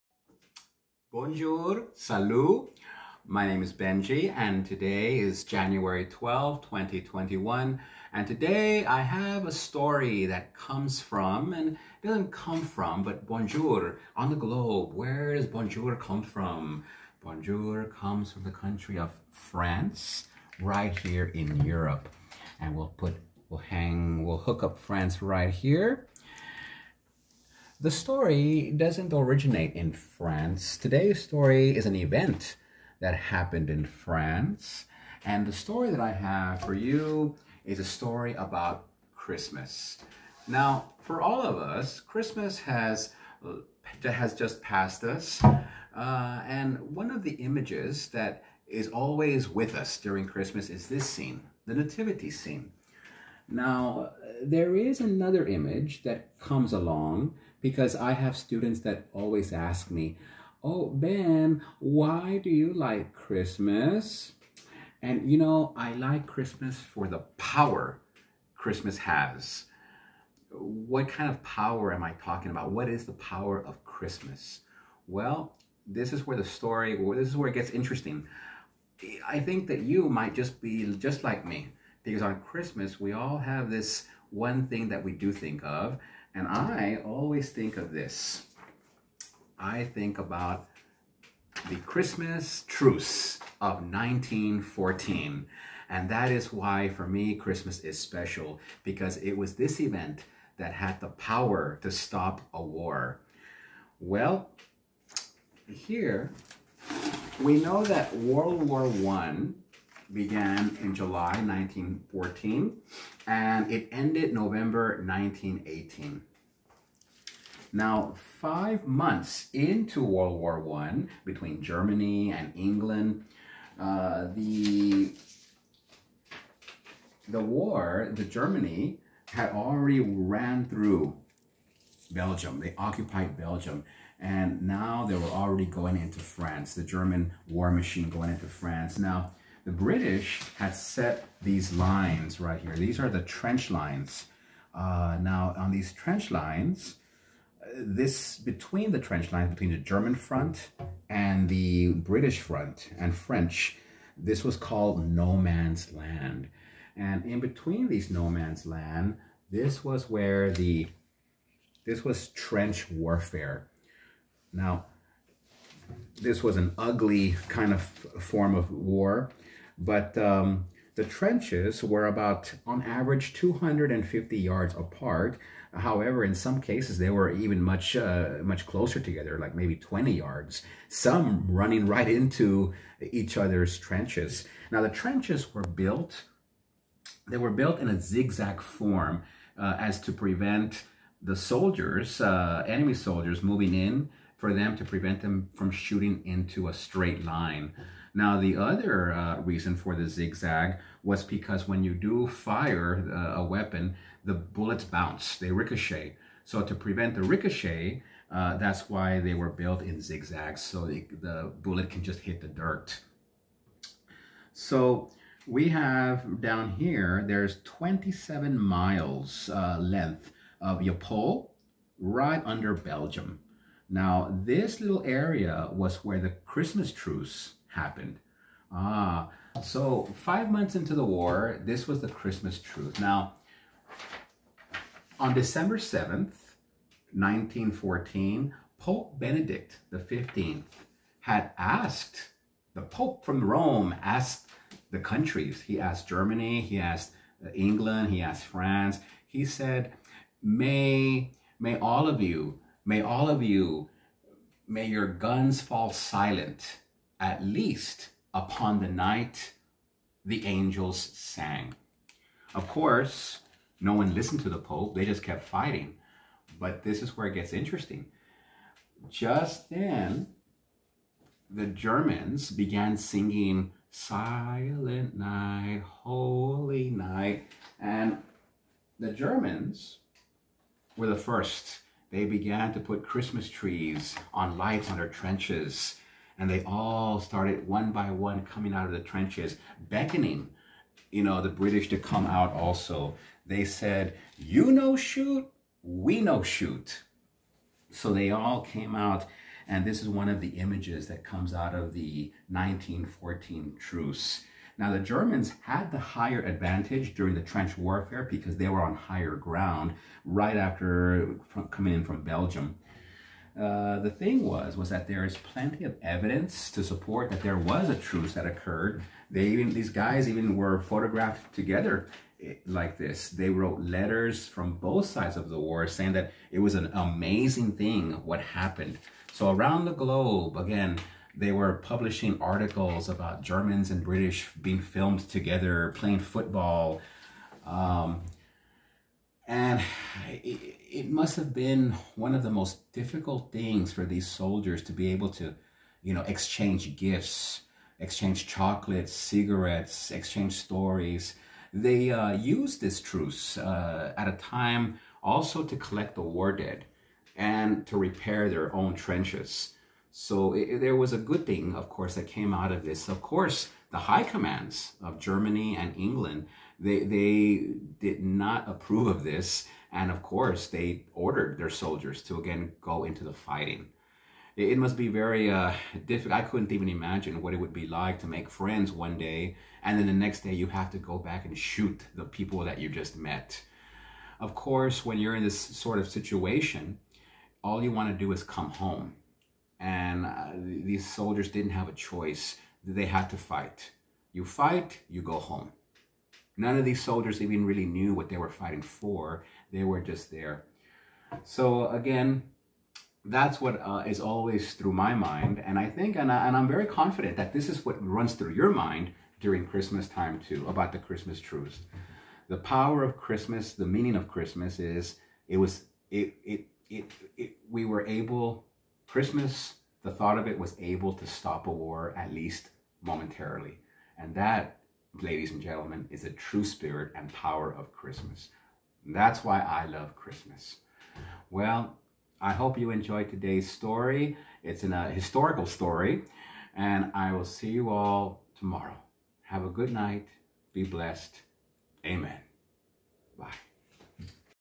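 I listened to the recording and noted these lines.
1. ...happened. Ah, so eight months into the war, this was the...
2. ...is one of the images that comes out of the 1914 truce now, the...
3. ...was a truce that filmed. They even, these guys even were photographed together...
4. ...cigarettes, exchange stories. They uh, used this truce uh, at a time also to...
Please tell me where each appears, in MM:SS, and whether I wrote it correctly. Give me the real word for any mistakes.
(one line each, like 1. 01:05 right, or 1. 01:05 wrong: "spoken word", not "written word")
1. 03:47 wrong: "five", not "eight"
2. 05:00 right
3. 05:17 wrong: "occurred", not "filmed"
4. 05:49 right.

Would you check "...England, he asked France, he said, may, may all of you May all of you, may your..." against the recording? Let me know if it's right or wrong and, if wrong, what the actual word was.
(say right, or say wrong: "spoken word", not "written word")
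right.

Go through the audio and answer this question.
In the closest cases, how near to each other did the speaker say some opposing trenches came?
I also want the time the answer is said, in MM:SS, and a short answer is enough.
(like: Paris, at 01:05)
20 yards, at 02:59.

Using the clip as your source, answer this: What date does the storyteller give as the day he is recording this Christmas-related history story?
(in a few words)
January 12, 2021.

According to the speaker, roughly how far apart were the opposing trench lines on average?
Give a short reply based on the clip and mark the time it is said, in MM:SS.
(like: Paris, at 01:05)
250 yards, at 02:53.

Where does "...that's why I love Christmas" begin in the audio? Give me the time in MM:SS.
07:09.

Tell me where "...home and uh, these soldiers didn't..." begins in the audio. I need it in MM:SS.
06:28.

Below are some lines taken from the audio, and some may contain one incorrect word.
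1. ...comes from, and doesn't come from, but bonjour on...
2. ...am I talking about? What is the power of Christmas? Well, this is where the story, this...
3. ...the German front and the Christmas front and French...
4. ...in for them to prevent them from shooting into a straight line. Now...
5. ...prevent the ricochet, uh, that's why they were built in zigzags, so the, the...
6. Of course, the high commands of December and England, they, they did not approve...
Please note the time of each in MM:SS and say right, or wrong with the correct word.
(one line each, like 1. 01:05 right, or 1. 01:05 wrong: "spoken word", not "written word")
1. 00:10 right
2. 01:11 right
3. 02:29 wrong: "British", not "Christmas"
4. 03:13 right
5. 03:26 right
6. 06:03 wrong: "Germany", not "December".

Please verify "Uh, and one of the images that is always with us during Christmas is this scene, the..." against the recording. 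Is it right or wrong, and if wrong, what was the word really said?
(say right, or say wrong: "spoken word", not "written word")
right.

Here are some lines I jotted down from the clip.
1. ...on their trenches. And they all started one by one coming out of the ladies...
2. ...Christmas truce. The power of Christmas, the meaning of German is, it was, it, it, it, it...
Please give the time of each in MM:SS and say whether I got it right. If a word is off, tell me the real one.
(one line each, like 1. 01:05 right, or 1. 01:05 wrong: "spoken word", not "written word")
1. 04:44 wrong: "trenches", not "ladies"
2. 06:50 wrong: "Christmas", not "German".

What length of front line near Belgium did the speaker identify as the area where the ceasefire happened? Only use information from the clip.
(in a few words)
27 miles.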